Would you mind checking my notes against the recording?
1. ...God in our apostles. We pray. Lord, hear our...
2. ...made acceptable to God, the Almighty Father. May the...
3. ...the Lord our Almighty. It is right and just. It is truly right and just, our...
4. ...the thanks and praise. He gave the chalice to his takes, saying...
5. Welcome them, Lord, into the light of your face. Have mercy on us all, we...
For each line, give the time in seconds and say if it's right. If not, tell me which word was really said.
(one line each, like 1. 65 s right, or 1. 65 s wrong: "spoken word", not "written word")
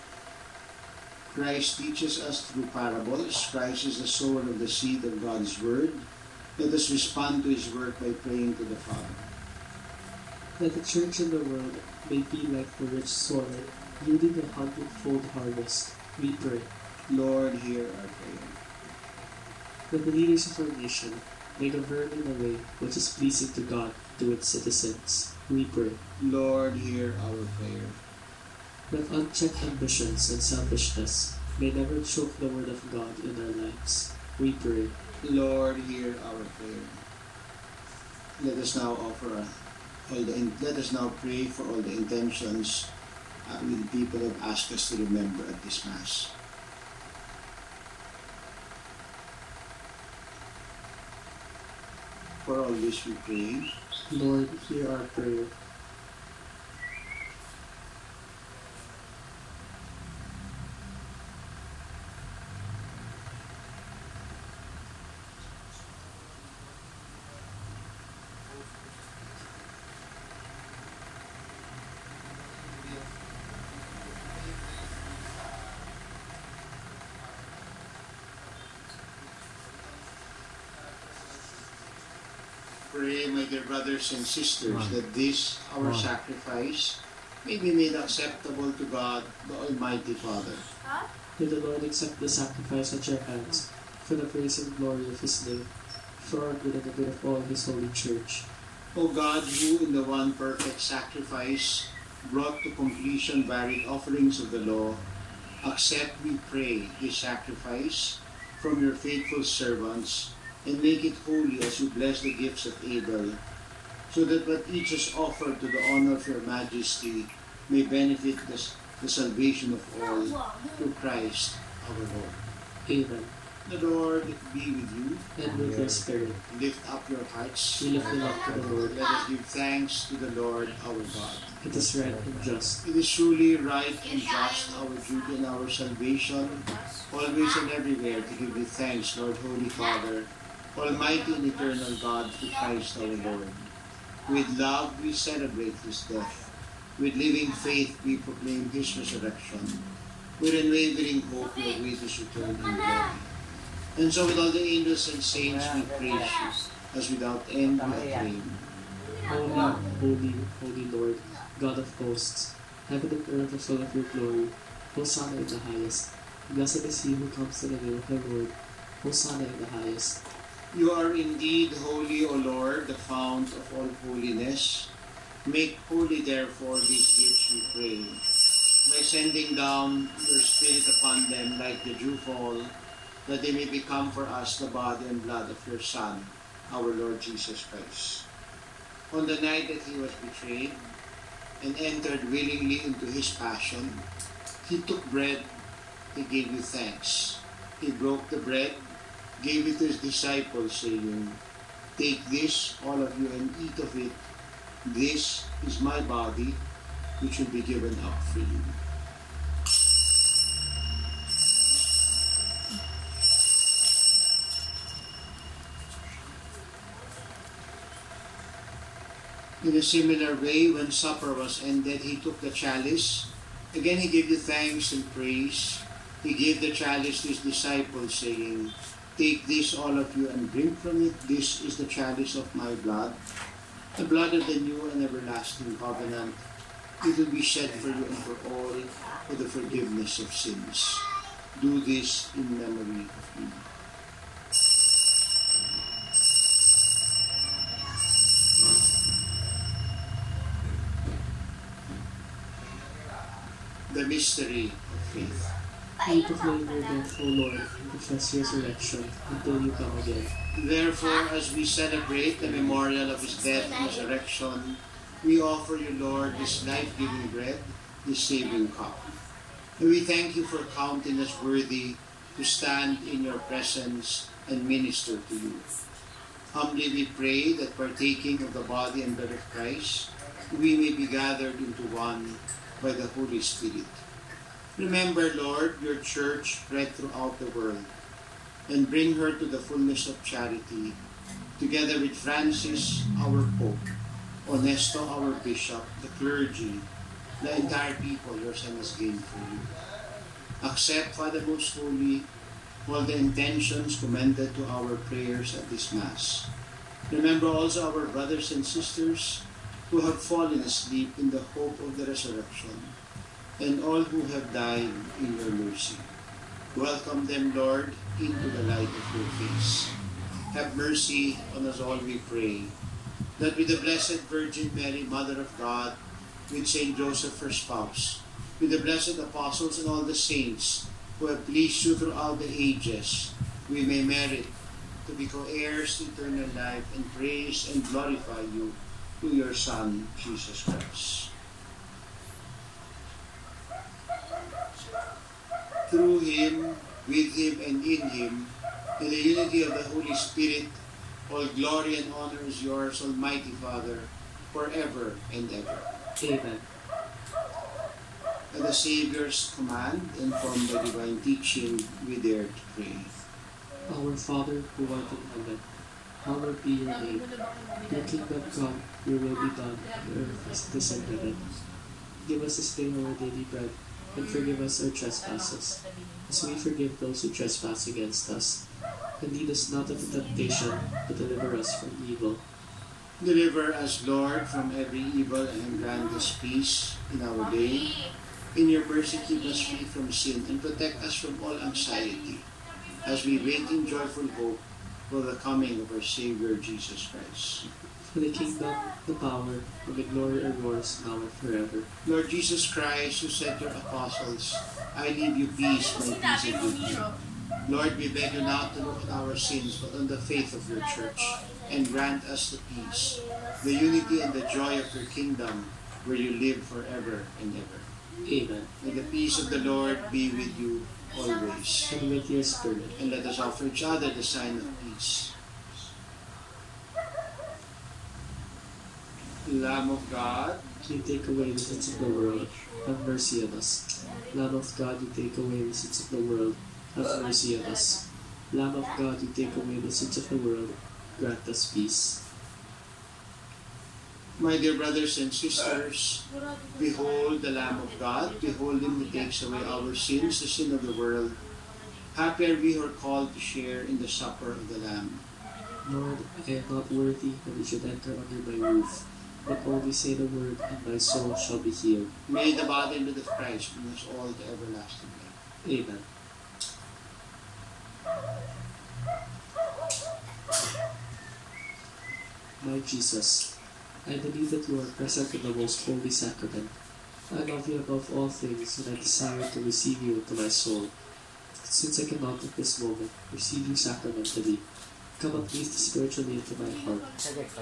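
1. 32 s wrong: "lives", not "apostles"
2. 87 s right
3. 130 s wrong: "God", not "Almighty"
4. 224 s wrong: "disciples", not "takes"
5. 316 s right.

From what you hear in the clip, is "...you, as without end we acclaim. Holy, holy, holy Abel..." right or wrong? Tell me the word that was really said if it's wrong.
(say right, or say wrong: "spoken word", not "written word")
wrong: "Lord", not "Abel".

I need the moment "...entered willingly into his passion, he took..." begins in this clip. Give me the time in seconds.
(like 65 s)
191 s.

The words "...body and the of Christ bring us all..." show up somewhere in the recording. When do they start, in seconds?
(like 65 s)
462 s.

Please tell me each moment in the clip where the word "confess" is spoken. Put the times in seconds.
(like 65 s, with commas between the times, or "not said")
257 s.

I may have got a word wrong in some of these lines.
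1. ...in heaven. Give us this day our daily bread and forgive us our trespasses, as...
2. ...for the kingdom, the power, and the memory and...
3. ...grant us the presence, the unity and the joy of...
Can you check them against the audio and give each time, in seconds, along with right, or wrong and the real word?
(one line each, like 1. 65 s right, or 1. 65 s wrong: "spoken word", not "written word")
1. 370 s right
2. 398 s wrong: "glory", not "memory"
3. 411 s wrong: "peace", not "presence".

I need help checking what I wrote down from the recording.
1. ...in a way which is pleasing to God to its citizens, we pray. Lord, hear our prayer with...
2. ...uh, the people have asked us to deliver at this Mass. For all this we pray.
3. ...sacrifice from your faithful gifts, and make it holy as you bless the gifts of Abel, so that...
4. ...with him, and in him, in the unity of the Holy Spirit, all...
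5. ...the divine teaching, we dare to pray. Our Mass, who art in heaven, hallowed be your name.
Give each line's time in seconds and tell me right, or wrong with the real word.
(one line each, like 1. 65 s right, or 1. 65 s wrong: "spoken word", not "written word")
1. 22 s right
2. 43 s wrong: "remember", not "deliver"
3. 107 s wrong: "servants", not "gifts"
4. 347 s right
5. 360 s wrong: "Father", not "Mass".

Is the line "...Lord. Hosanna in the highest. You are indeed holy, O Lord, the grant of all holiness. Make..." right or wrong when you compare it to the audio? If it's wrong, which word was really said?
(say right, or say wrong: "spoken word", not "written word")
wrong: "fount", not "grant".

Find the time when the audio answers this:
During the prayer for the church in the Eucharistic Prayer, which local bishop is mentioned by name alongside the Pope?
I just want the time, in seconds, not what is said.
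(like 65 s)
294 s.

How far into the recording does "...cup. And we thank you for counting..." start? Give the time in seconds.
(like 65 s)
268 s.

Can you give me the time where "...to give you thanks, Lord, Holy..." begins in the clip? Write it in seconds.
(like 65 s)
138 s.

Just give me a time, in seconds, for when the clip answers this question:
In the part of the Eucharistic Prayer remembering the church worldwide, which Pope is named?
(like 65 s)
292 s.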